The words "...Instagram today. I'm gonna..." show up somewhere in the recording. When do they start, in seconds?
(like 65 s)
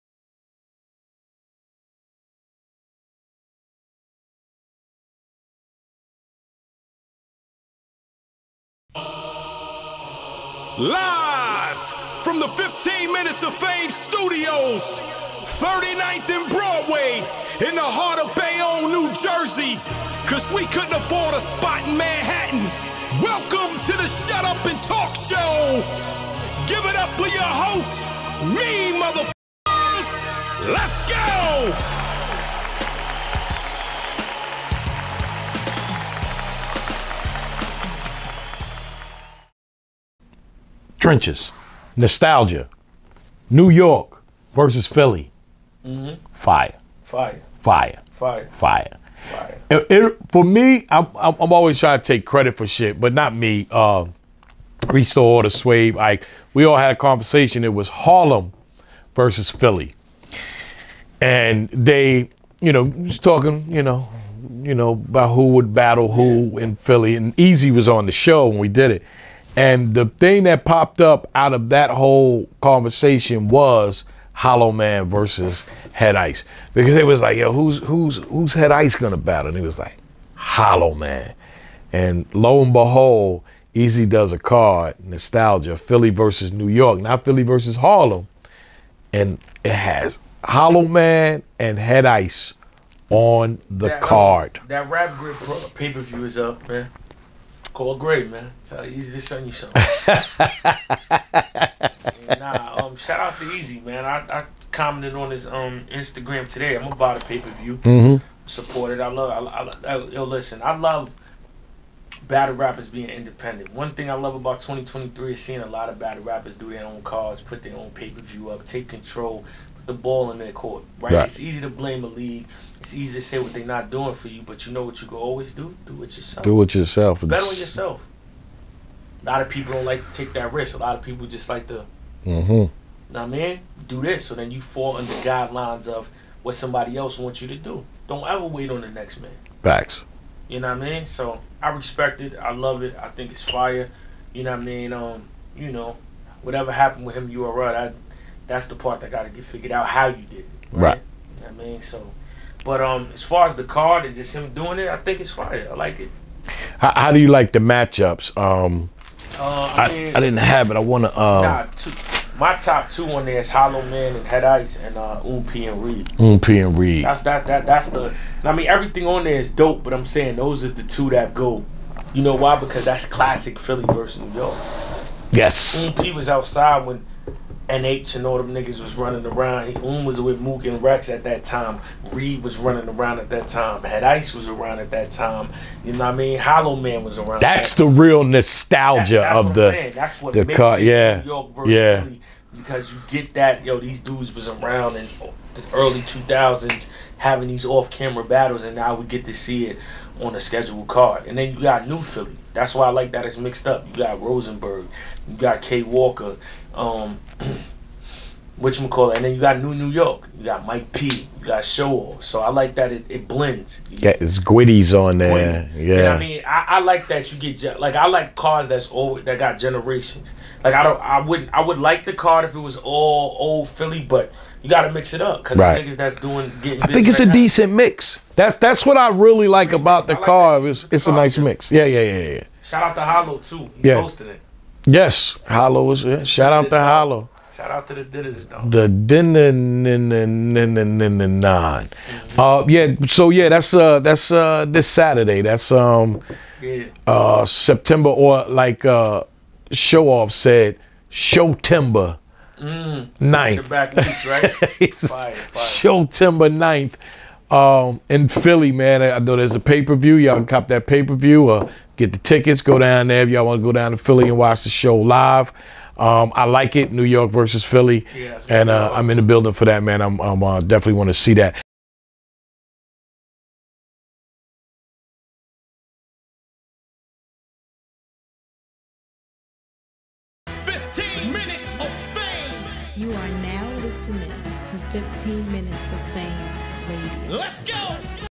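105 s.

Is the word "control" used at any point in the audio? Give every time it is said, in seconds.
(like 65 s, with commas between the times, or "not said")
118 s.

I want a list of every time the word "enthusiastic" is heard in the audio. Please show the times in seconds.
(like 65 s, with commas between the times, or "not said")
not said.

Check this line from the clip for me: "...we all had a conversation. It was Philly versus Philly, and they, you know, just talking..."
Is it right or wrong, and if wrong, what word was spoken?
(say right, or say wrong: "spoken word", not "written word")
wrong: "Harlem", not "Philly".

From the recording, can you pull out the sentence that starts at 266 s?
Um, I like it, New York versus Philly, yeah, and uh, I'm in the building for that, man.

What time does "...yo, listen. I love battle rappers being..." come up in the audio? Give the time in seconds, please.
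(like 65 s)
110 s.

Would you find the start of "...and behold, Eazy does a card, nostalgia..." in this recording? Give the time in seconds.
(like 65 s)
82 s.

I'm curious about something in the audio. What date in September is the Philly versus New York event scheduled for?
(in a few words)
September 9th.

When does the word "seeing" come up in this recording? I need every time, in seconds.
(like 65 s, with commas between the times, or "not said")
115 s.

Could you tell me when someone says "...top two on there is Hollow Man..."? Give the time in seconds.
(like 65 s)
162 s.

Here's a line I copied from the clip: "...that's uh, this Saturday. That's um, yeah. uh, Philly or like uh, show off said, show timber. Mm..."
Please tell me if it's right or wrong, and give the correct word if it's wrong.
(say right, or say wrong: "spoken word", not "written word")
wrong: "September", not "Philly".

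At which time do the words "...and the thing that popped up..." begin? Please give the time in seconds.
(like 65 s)
69 s.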